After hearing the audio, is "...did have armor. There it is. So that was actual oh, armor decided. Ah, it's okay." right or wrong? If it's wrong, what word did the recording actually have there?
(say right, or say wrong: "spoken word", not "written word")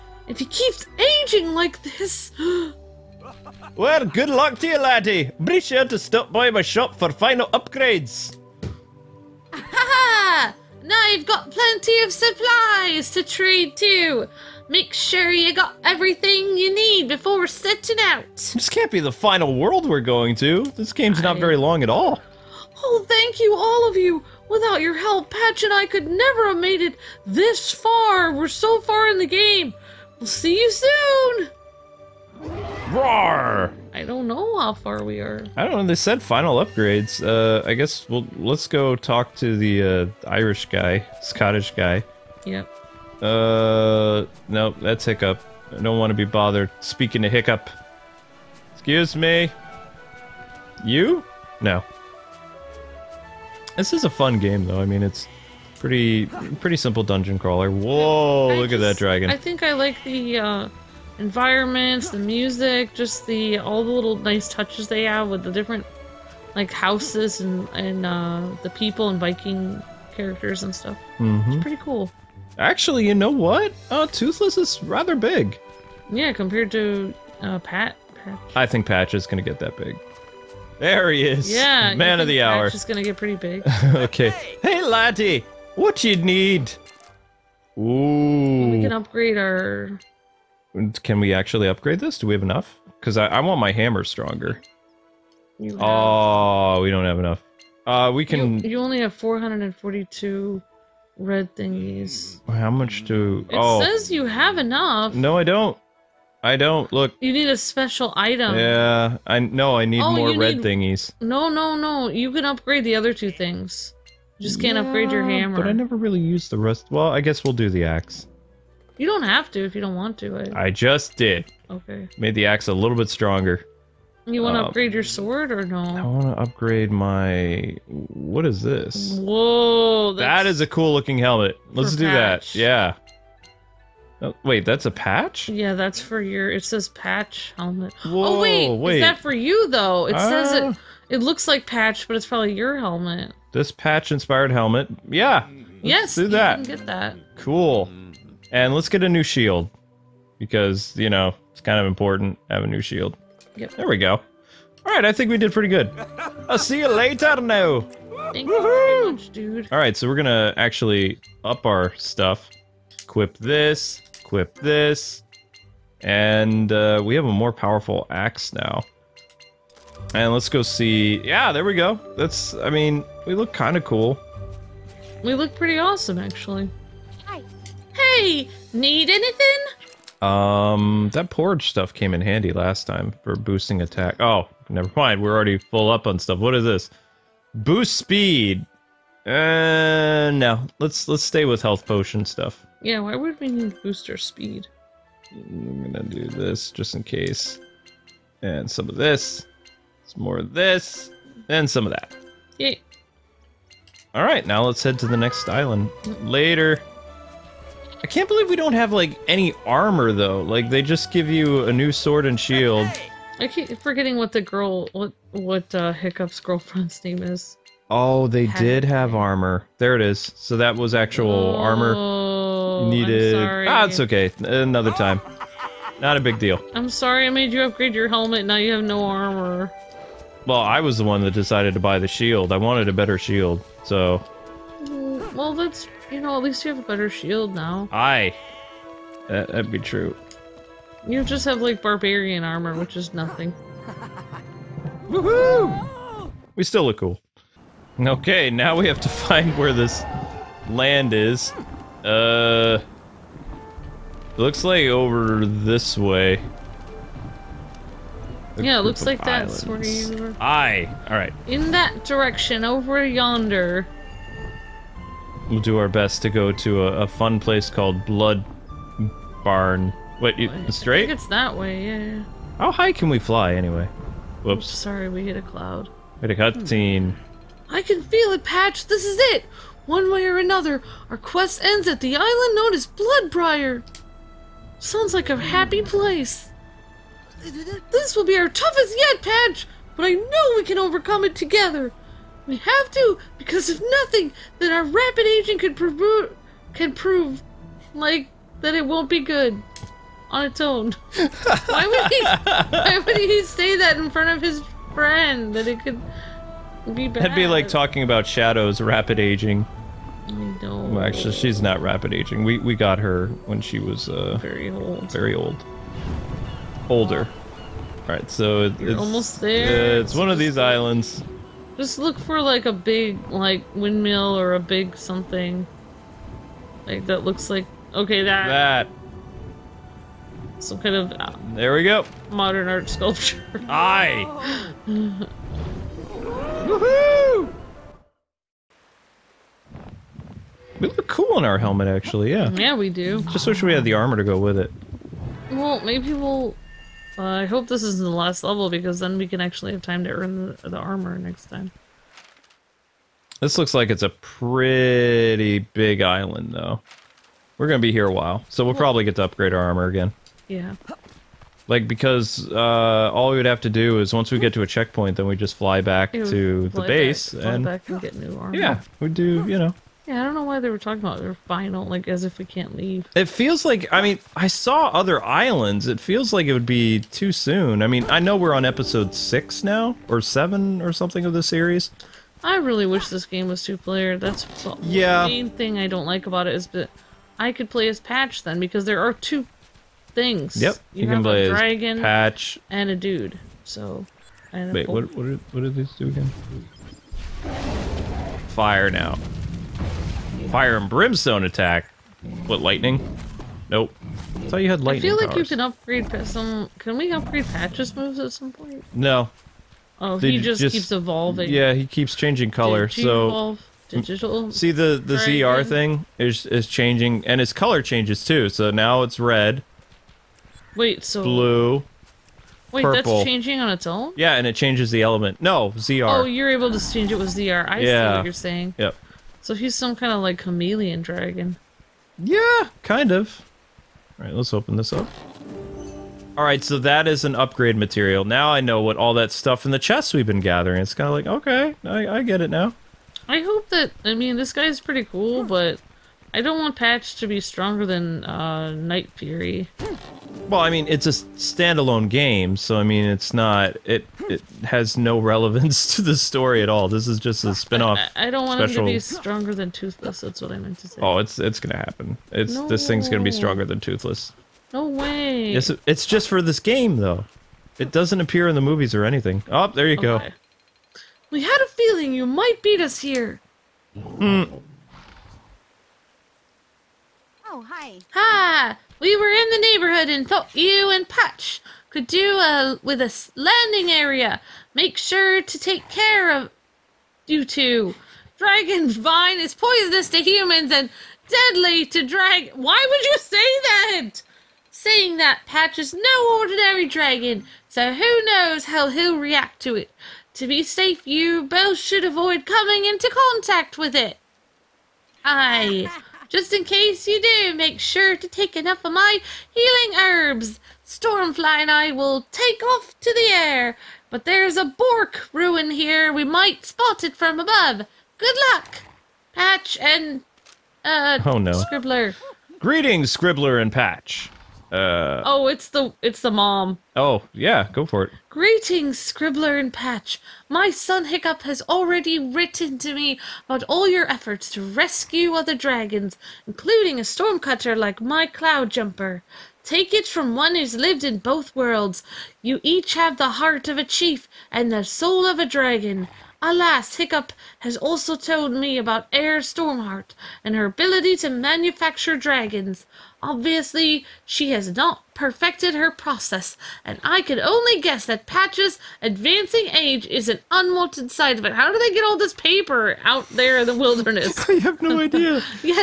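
wrong: "needed", not "decided".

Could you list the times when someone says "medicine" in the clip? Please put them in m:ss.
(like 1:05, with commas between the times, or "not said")
not said.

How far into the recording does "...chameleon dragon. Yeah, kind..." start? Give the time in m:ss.
7:10.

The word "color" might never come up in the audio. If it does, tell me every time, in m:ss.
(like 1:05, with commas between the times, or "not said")
6:52, 6:57.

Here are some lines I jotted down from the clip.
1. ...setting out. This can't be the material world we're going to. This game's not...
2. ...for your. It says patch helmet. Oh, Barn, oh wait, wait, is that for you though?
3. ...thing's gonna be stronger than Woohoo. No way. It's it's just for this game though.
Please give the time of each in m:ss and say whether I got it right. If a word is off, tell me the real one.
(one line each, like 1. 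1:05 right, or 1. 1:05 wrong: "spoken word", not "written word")
1. 0:17 wrong: "final", not "material"
2. 2:16 wrong: "Whoa", not "Barn"
3. 7:42 wrong: "Toothless", not "Woohoo".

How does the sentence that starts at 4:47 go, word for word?
This will be our toughest yet, Patch, but I know we can overcome it together.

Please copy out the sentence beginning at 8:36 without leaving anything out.
We might spot it from above.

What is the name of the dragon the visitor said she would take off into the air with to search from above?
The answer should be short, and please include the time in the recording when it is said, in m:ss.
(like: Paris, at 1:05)
Stormfly, at 8:30.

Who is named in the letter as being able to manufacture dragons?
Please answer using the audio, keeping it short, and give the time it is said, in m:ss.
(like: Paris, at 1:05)
Eir Stormheart, at 9:09.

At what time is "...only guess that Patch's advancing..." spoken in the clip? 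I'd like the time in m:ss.
9:17.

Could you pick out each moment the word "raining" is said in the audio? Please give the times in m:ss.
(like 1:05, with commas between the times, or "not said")
not said.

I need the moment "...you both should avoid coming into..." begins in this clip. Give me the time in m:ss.
8:21.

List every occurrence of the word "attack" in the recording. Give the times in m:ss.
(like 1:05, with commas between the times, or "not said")
3:03, 6:41.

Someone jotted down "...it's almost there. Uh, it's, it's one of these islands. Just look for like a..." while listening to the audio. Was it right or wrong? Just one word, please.
right.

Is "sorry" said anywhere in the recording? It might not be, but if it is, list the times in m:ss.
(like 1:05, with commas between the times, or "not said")
3:46, 4:34.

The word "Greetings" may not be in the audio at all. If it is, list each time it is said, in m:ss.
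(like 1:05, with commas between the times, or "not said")
8:42, 8:48.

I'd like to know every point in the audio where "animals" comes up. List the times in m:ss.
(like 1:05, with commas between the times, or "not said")
not said.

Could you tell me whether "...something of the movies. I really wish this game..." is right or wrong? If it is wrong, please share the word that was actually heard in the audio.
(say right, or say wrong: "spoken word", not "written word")
wrong: "series", not "movies".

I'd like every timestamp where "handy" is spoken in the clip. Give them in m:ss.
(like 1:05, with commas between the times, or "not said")
3:02.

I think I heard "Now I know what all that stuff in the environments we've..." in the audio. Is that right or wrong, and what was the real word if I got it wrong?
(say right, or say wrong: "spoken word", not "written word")
wrong: "chests", not "environments".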